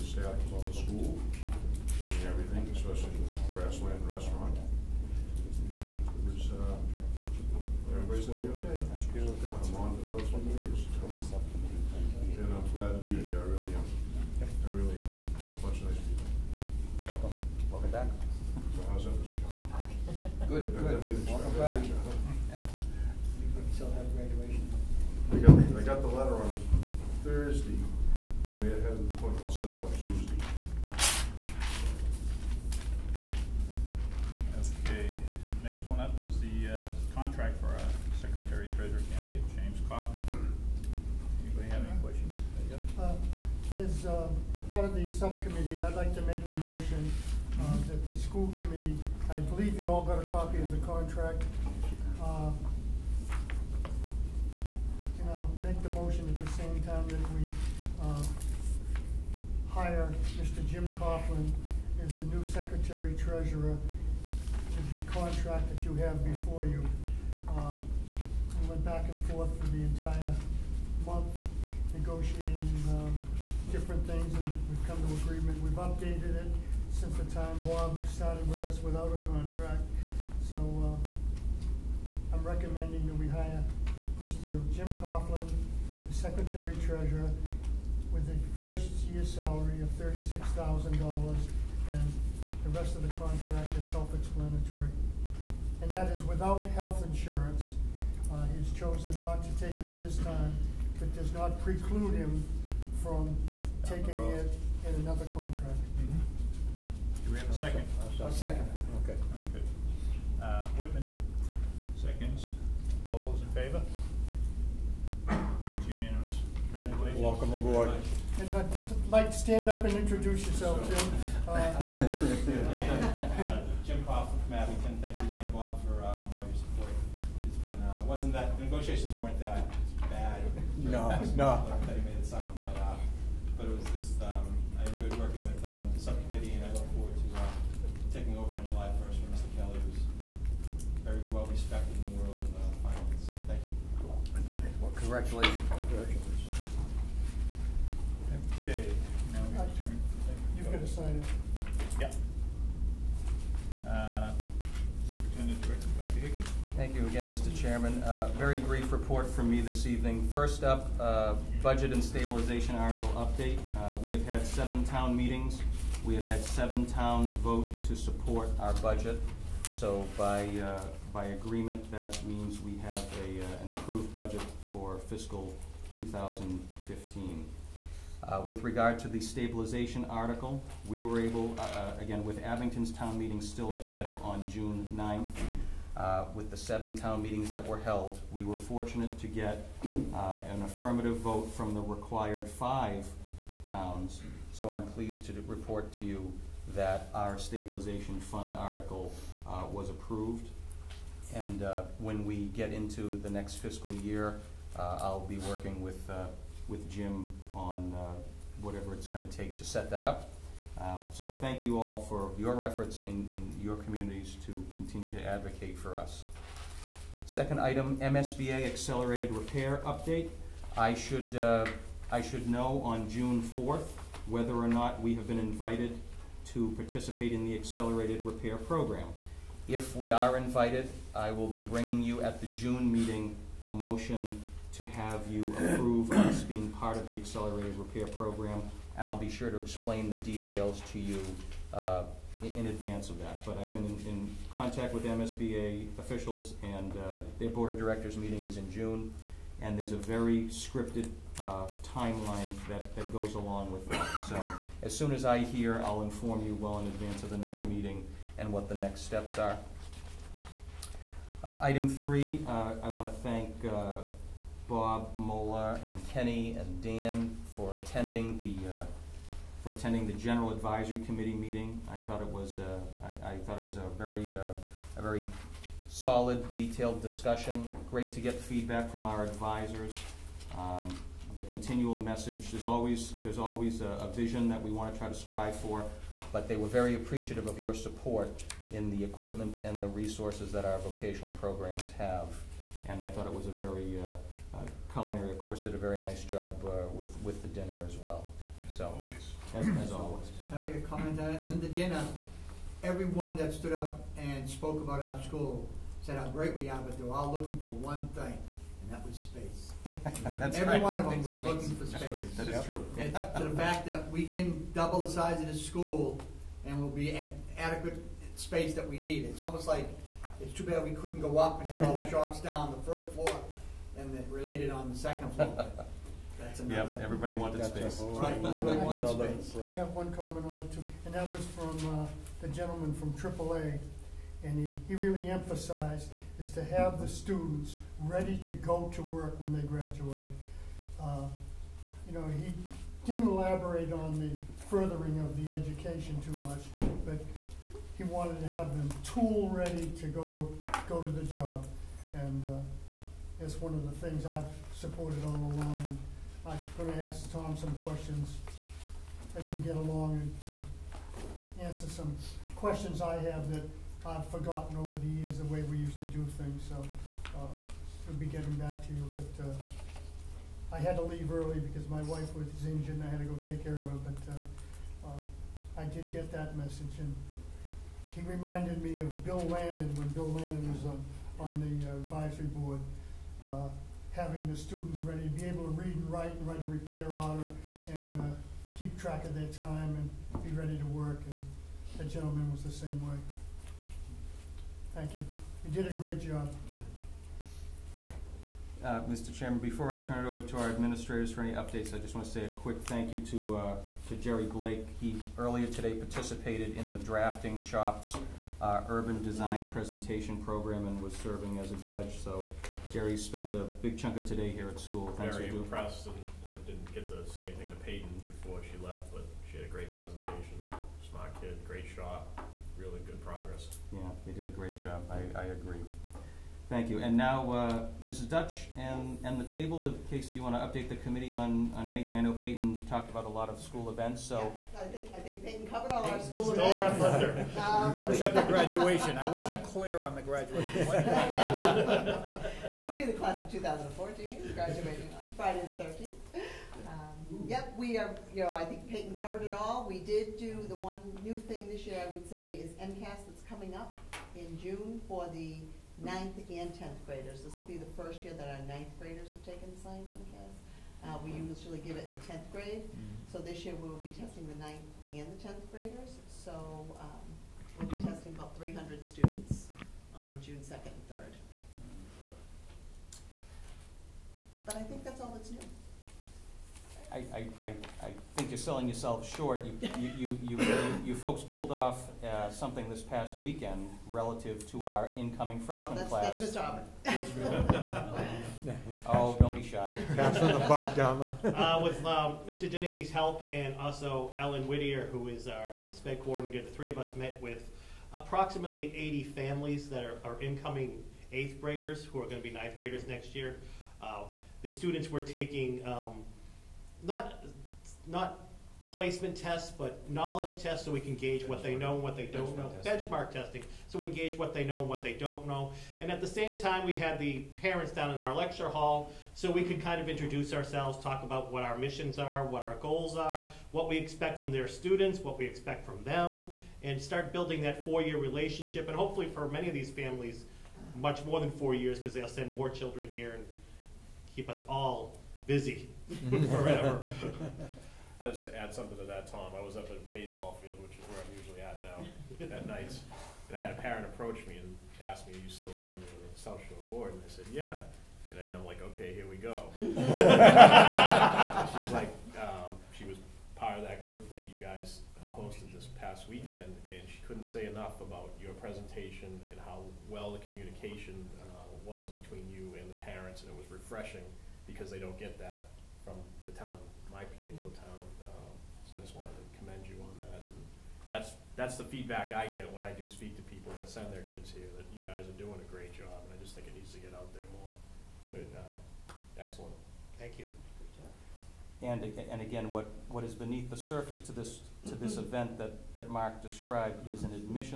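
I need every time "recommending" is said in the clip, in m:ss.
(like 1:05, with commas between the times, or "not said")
1:22.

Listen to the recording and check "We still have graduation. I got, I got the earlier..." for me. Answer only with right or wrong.
wrong.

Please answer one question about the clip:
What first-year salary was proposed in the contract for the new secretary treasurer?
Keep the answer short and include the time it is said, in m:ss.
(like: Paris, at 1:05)
$36,000, at 1:29.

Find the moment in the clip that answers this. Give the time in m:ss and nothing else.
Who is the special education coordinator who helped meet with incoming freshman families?
8:14.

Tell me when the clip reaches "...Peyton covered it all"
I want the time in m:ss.
7:28.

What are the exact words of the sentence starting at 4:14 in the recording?
So as soon as I hear, I'll inform you well in advance of the next meeting and what the next steps are.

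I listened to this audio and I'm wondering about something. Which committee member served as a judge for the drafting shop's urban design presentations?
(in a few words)
Jerry Blake.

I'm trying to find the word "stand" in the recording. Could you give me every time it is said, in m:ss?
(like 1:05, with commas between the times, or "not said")
1:59.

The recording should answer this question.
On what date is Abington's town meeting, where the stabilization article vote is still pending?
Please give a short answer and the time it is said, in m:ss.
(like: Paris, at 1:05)
June 9th, at 3:04.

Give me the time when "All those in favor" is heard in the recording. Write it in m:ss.
1:53.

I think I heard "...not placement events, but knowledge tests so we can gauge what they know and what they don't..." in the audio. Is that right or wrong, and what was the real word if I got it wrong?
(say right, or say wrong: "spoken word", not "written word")
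wrong: "tests", not "events".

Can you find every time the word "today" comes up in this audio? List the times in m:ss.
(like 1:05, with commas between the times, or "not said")
6:45, 6:54.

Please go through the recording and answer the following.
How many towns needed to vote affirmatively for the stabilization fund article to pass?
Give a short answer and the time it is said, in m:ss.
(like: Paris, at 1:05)
5, at 3:12.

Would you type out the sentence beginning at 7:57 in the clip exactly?
I, I, I think you're selling yourself short.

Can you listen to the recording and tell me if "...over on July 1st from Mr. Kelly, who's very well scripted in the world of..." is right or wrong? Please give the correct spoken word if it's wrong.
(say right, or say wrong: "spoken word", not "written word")
wrong: "respected", not "scripted".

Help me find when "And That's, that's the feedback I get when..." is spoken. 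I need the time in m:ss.
9:30.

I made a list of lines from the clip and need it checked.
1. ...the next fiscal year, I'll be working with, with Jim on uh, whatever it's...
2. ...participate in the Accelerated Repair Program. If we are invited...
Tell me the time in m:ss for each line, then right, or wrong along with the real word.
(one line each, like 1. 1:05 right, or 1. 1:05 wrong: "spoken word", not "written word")
1. 3:23 right
2. 3:46 right.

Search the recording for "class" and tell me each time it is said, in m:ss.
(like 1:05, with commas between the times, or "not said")
7:23, 8:06.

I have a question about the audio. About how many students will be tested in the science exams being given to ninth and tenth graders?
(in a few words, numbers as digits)
300.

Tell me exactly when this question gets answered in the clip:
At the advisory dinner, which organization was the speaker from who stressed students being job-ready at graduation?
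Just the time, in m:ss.
5:33.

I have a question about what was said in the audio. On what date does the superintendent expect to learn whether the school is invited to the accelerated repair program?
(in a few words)
June 4th.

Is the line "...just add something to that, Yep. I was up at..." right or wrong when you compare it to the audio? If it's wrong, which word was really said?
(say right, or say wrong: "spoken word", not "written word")
wrong: "Tom", not "Yep".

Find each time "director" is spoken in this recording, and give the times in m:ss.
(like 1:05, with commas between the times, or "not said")
2:35, 4:07.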